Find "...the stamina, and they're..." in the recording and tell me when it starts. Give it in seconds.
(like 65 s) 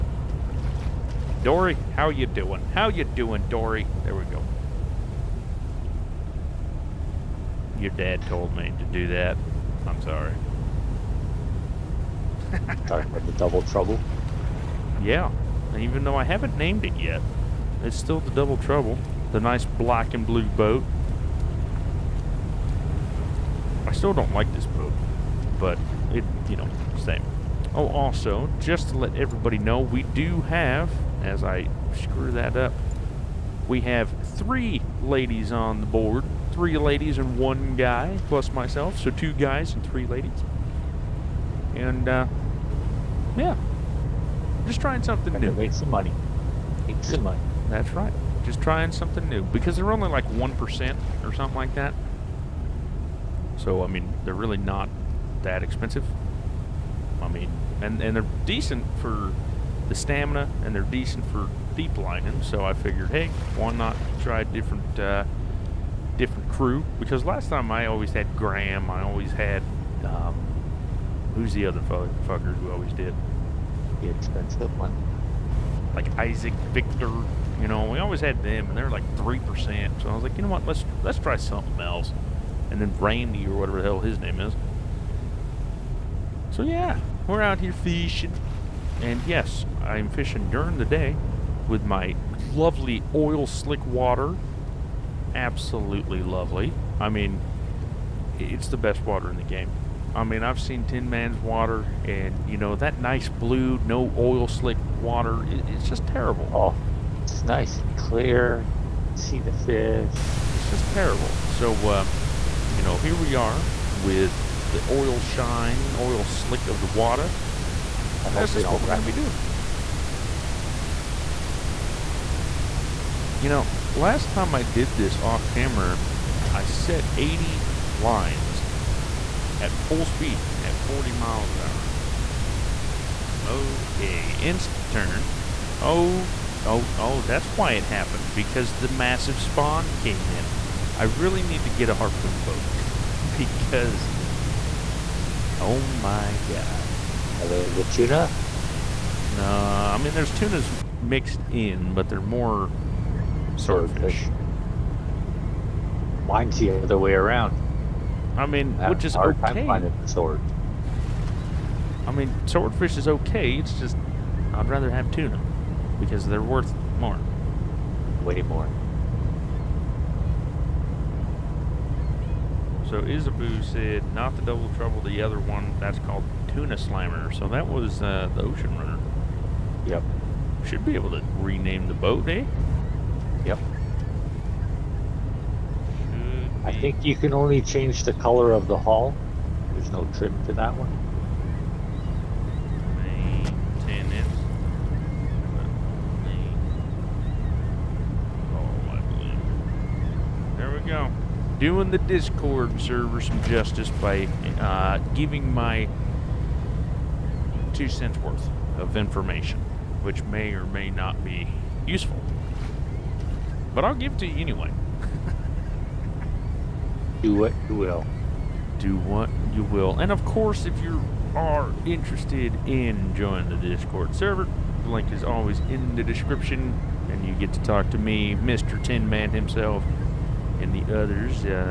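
59 s.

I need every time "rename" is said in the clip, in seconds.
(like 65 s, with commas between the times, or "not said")
181 s.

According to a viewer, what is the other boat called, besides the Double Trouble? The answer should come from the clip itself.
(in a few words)
Tuna Slammer.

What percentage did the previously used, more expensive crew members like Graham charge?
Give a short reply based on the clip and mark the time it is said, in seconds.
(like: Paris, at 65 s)
3%, at 79 s.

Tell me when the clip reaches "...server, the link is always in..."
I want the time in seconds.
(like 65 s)
224 s.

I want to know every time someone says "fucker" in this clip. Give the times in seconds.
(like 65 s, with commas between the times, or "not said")
71 s.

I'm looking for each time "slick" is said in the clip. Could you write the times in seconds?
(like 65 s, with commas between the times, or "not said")
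93 s, 104 s, 116 s.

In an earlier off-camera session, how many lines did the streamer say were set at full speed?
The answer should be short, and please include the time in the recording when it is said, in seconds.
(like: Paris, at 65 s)
80, at 127 s.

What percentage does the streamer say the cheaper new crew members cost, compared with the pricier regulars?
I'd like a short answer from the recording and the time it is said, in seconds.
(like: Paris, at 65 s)
1%, at 50 s.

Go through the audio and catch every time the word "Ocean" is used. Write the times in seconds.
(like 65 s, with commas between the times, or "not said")
178 s.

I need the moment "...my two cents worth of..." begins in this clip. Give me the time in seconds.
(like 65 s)
205 s.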